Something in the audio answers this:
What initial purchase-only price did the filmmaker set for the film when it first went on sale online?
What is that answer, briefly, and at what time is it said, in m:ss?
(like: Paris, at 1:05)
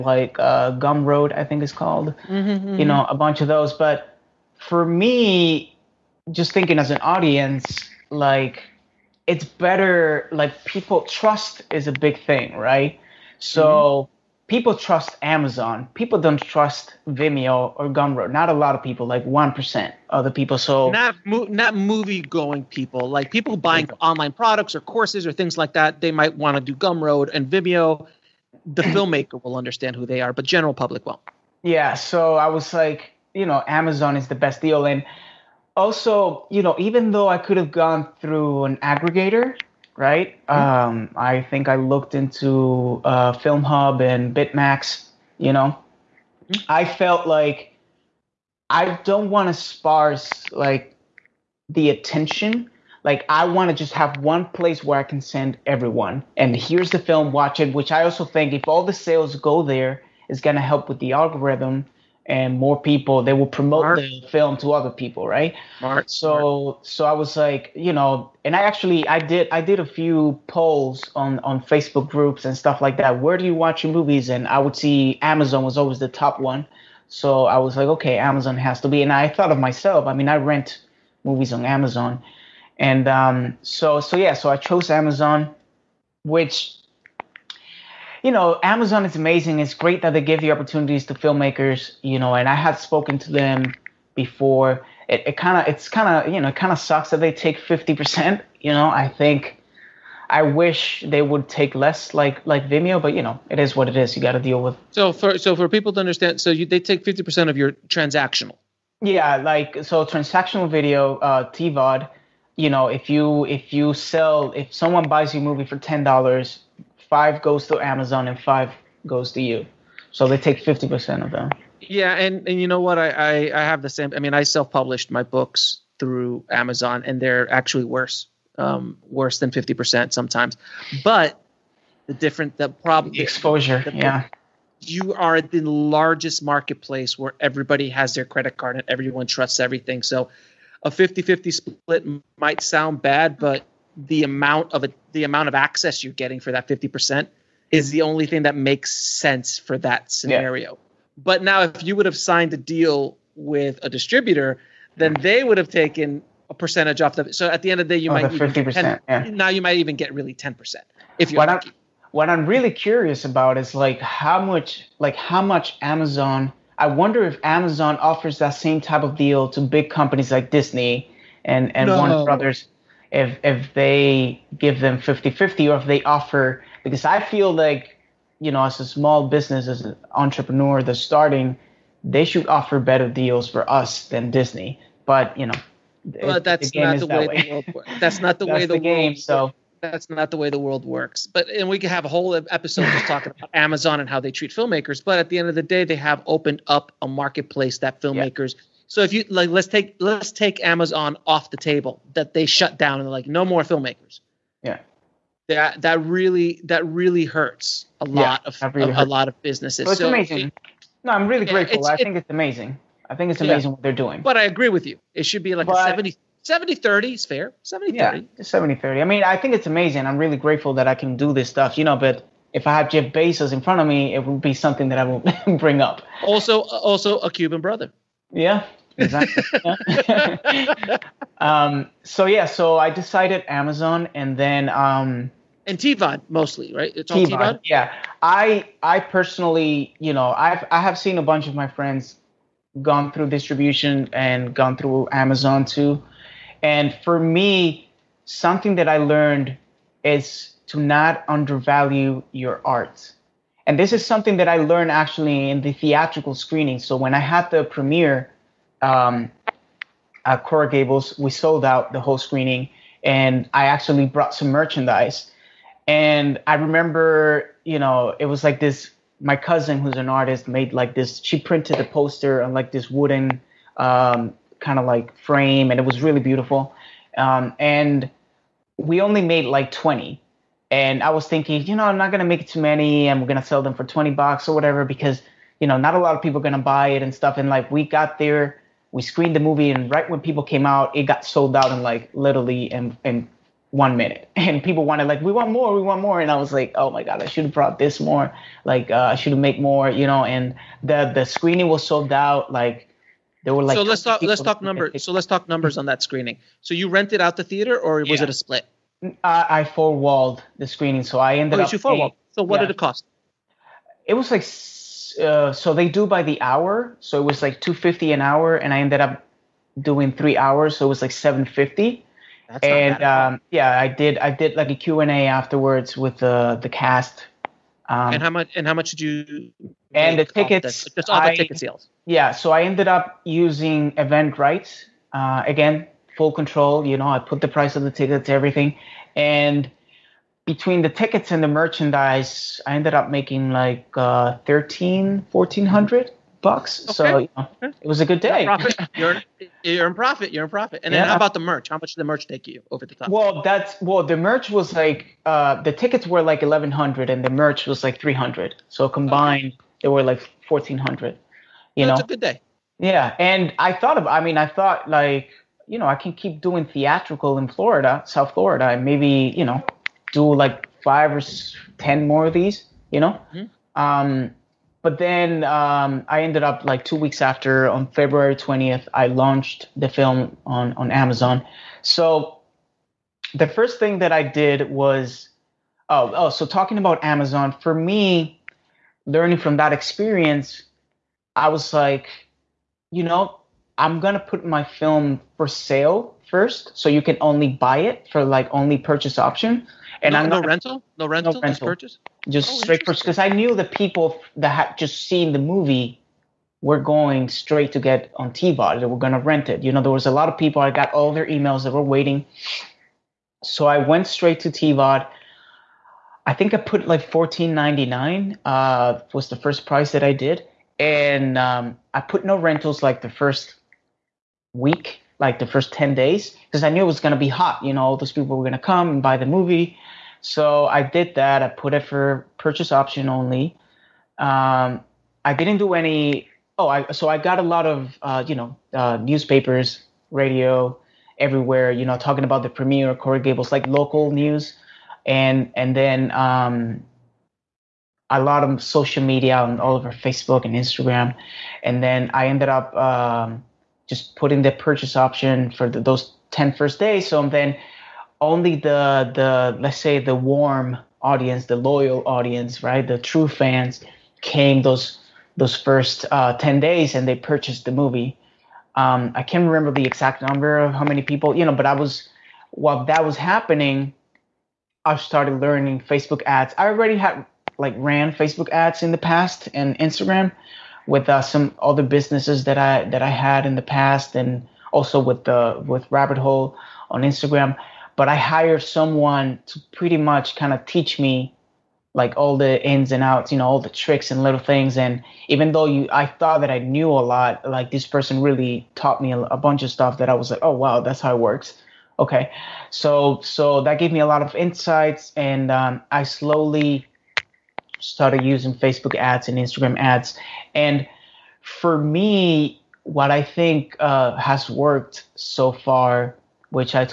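$14.99, at 6:57.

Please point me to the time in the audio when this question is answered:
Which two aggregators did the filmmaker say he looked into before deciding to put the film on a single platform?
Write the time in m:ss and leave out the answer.
0:43.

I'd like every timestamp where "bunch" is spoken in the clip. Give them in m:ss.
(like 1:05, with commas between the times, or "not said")
0:03, 4:01, 8:19.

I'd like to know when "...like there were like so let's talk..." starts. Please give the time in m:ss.
5:02.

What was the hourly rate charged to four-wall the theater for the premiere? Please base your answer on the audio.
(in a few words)
$250.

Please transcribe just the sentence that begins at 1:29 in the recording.
It's great that they give the opportunities to filmmakers, you know, and I had spoken to them before.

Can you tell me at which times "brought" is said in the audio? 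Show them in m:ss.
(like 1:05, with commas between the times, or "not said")
4:24, 4:57.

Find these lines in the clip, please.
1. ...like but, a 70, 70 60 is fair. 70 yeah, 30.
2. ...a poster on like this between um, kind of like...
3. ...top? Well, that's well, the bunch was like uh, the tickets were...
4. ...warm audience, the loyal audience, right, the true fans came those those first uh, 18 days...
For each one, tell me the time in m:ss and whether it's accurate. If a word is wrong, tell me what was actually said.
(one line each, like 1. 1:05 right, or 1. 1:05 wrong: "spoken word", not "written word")
1. 3:35 wrong: "30", not "60"
2. 4:31 wrong: "wooden", not "between"
3. 5:52 wrong: "merch", not "bunch"
4. 7:40 wrong: "10", not "18".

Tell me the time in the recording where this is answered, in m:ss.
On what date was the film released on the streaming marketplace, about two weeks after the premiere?
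6:17.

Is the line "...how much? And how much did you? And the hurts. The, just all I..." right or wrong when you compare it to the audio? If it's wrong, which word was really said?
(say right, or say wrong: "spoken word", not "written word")
wrong: "tickets", not "hurts".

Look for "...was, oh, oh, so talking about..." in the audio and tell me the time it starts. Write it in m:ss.
6:24.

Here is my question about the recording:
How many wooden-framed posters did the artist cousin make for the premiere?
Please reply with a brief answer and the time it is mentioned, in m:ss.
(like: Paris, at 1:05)
20, at 4:39.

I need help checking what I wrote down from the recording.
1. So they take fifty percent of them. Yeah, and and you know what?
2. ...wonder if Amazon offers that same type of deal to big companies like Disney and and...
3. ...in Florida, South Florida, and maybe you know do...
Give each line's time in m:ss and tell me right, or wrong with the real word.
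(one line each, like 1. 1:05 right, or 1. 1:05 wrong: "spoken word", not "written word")
1. 2:00 right
2. 2:46 right
3. 6:07 right.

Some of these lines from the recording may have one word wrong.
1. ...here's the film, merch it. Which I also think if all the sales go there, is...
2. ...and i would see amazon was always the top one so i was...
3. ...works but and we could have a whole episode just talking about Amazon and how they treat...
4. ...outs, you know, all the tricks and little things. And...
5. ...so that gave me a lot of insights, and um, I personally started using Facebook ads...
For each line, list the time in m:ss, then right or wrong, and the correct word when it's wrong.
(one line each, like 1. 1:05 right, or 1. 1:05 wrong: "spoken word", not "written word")
1. 0:56 wrong: "watch", not "merch"
2. 1:14 right
3. 3:10 right
4. 8:13 right
5. 8:23 wrong: "slowly", not "personally".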